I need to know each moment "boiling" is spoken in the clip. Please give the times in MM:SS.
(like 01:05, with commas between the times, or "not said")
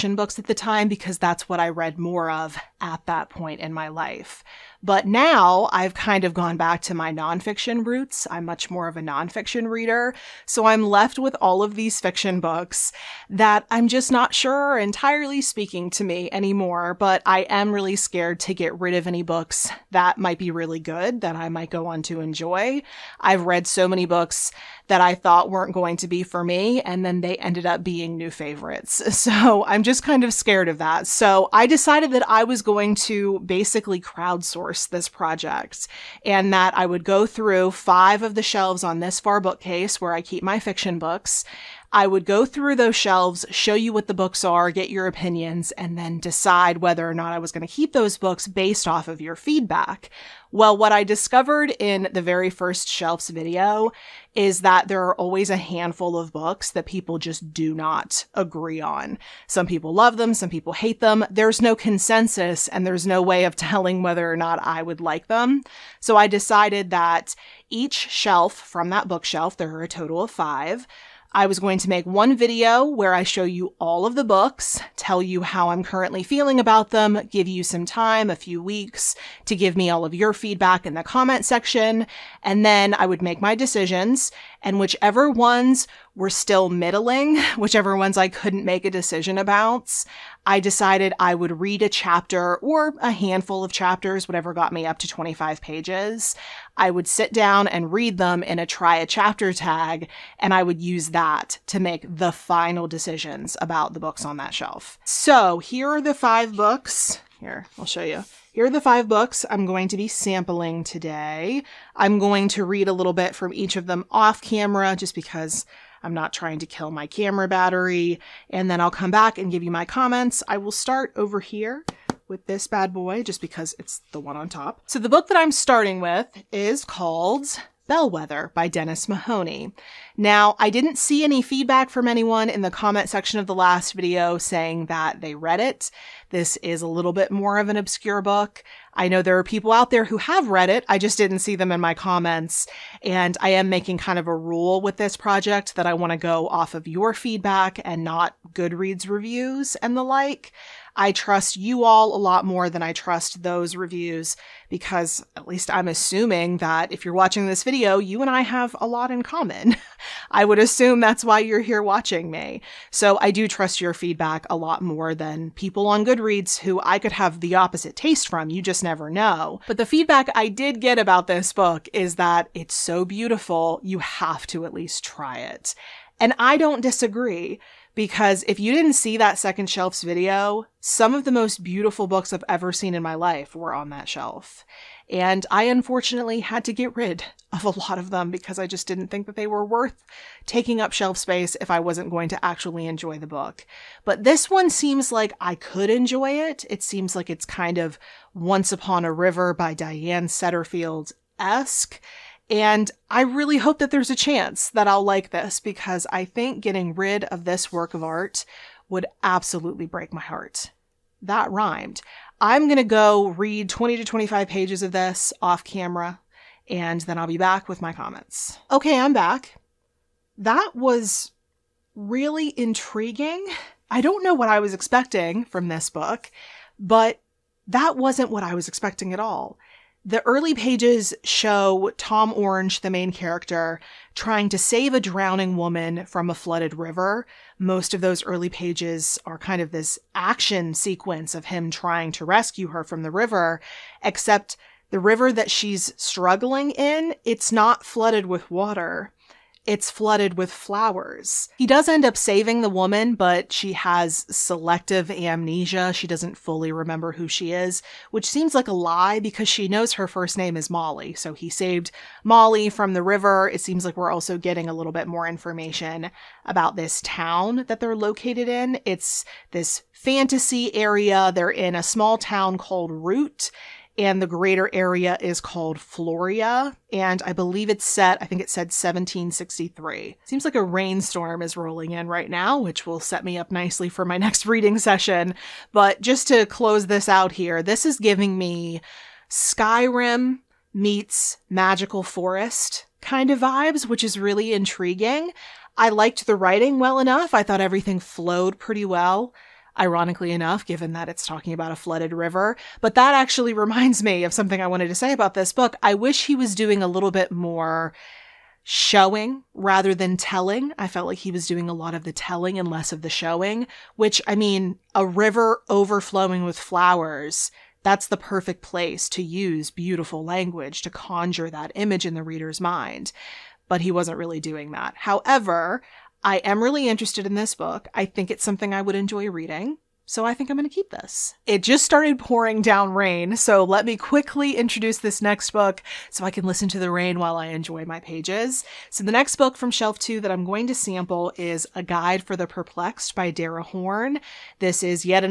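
not said.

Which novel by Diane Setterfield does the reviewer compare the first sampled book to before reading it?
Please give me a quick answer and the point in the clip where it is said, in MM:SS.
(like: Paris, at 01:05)
Once Upon a River, at 03:18.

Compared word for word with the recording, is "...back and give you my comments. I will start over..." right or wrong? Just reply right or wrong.
right.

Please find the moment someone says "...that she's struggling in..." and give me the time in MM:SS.
04:05.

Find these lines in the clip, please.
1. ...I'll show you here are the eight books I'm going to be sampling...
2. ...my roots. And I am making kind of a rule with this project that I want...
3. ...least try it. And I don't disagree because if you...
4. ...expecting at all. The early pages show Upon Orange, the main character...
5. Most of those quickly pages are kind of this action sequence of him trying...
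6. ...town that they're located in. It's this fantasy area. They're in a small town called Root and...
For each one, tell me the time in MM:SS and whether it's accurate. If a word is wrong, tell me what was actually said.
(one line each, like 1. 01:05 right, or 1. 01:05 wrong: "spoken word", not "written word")
1. 01:47 wrong: "five", not "eight"
2. 02:21 wrong: "comments", not "roots"
3. 02:54 right
4. 03:48 wrong: "Tom", not "Upon"
5. 03:57 wrong: "early", not "quickly"
6. 04:27 right.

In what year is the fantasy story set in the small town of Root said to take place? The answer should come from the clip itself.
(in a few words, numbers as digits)
1763.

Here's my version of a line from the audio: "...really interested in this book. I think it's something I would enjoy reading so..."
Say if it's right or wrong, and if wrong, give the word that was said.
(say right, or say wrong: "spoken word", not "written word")
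right.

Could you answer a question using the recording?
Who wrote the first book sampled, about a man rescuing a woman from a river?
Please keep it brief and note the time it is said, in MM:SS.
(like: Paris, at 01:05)
Dennis Mahoney, at 02:08.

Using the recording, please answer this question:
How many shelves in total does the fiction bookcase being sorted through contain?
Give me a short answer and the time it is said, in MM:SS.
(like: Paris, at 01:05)
5, at 01:09.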